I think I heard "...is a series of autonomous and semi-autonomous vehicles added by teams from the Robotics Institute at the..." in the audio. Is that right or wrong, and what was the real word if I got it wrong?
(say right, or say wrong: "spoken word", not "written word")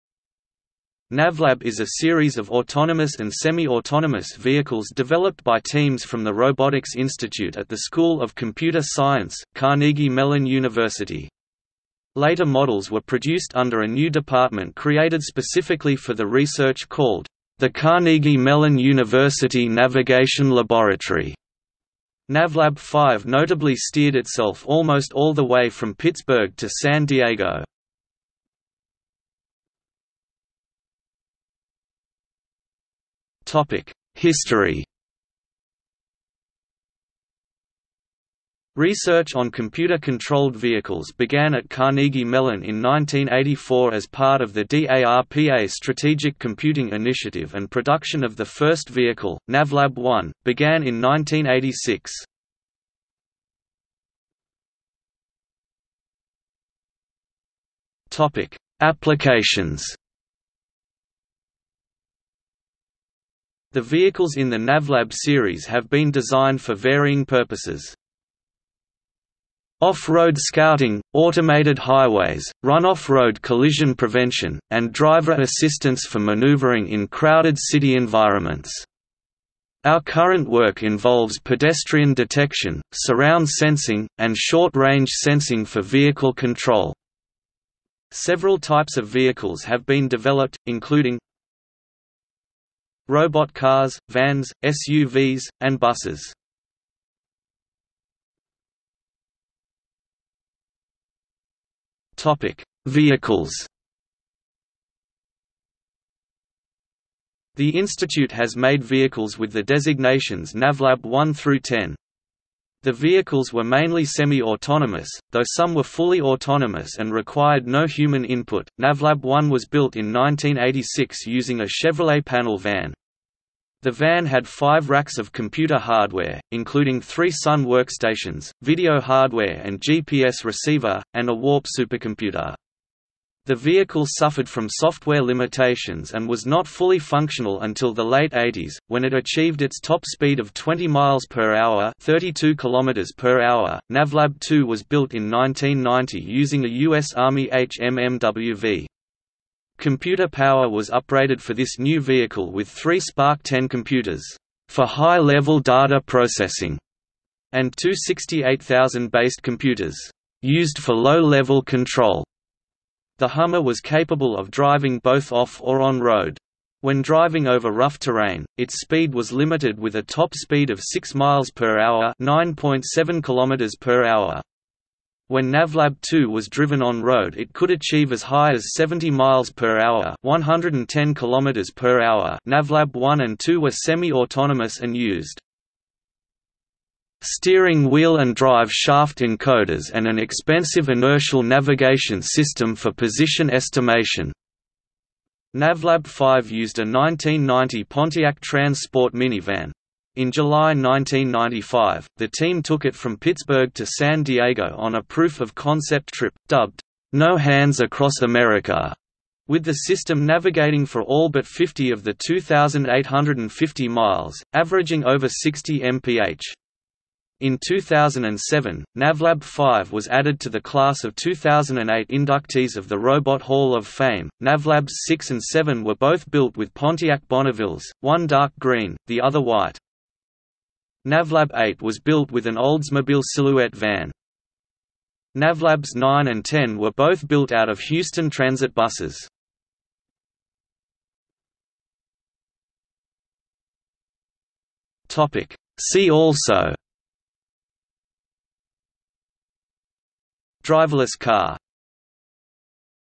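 wrong: "developed", not "added".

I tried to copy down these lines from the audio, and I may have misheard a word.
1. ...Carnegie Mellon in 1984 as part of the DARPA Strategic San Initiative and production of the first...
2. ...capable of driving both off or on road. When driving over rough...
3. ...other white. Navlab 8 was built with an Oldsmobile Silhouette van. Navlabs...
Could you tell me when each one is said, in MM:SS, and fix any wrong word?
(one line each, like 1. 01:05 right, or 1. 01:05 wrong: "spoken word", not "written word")
1. 00:41 wrong: "Computing", not "San"
2. 02:43 right
3. 03:49 right.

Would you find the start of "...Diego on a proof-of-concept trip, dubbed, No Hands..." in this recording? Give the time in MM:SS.
03:24.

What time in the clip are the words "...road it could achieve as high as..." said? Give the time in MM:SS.
02:57.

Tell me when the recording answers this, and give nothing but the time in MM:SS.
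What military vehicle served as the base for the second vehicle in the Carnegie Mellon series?
02:26.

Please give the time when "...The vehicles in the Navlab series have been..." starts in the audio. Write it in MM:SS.
01:03.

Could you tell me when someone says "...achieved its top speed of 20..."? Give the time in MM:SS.
02:19.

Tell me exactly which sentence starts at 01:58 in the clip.
Navlab 1 was built in 1986 using a Chevrolet panel van.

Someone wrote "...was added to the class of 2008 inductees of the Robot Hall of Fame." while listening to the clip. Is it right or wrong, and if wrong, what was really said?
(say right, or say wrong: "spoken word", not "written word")
right.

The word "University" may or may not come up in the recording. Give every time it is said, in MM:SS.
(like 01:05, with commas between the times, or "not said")
00:10, 00:18.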